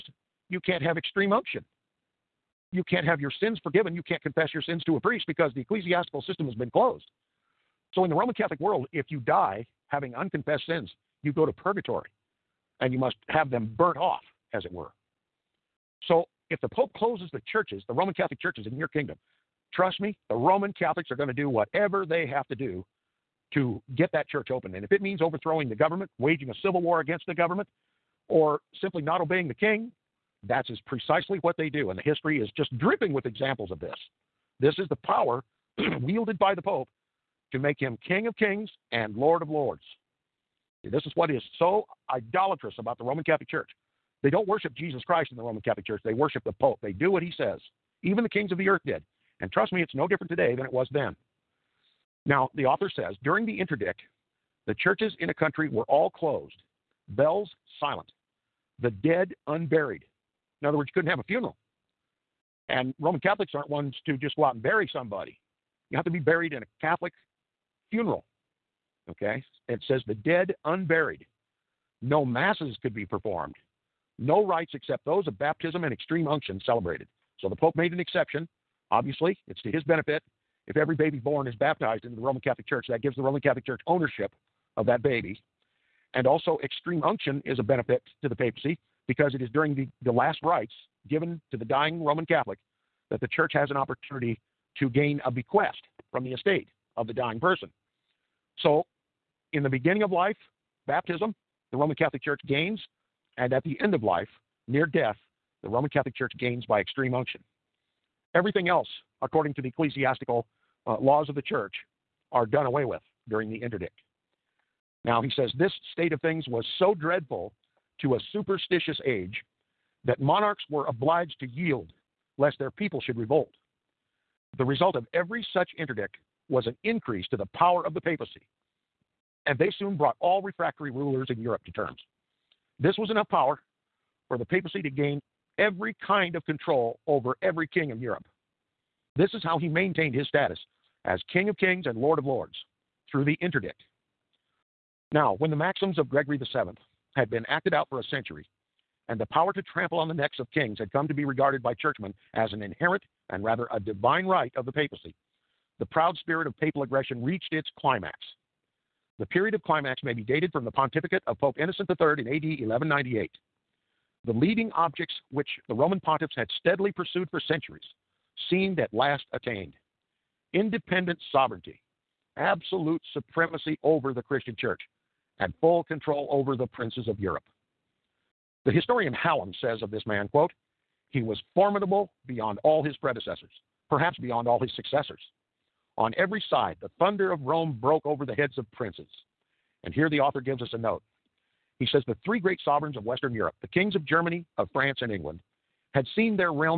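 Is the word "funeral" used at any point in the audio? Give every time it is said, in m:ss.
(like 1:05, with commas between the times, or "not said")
1:01, 1:07.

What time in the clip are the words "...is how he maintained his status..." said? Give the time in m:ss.
2:19.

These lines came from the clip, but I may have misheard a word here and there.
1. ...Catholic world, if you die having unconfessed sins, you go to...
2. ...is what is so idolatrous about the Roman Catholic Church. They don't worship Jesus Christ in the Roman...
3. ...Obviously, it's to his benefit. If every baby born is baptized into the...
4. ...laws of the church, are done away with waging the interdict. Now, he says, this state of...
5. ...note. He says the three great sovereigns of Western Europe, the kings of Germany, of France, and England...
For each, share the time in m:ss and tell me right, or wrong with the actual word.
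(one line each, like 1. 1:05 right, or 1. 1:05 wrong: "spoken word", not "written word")
1. 0:08 right
2. 0:41 right
3. 1:18 right
4. 1:50 wrong: "during", not "waging"
5. 3:10 right.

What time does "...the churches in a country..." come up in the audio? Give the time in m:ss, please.
0:54.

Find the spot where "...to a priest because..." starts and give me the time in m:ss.
0:04.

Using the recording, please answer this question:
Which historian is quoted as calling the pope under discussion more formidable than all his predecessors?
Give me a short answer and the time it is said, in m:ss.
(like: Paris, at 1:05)
Hallam, at 2:59.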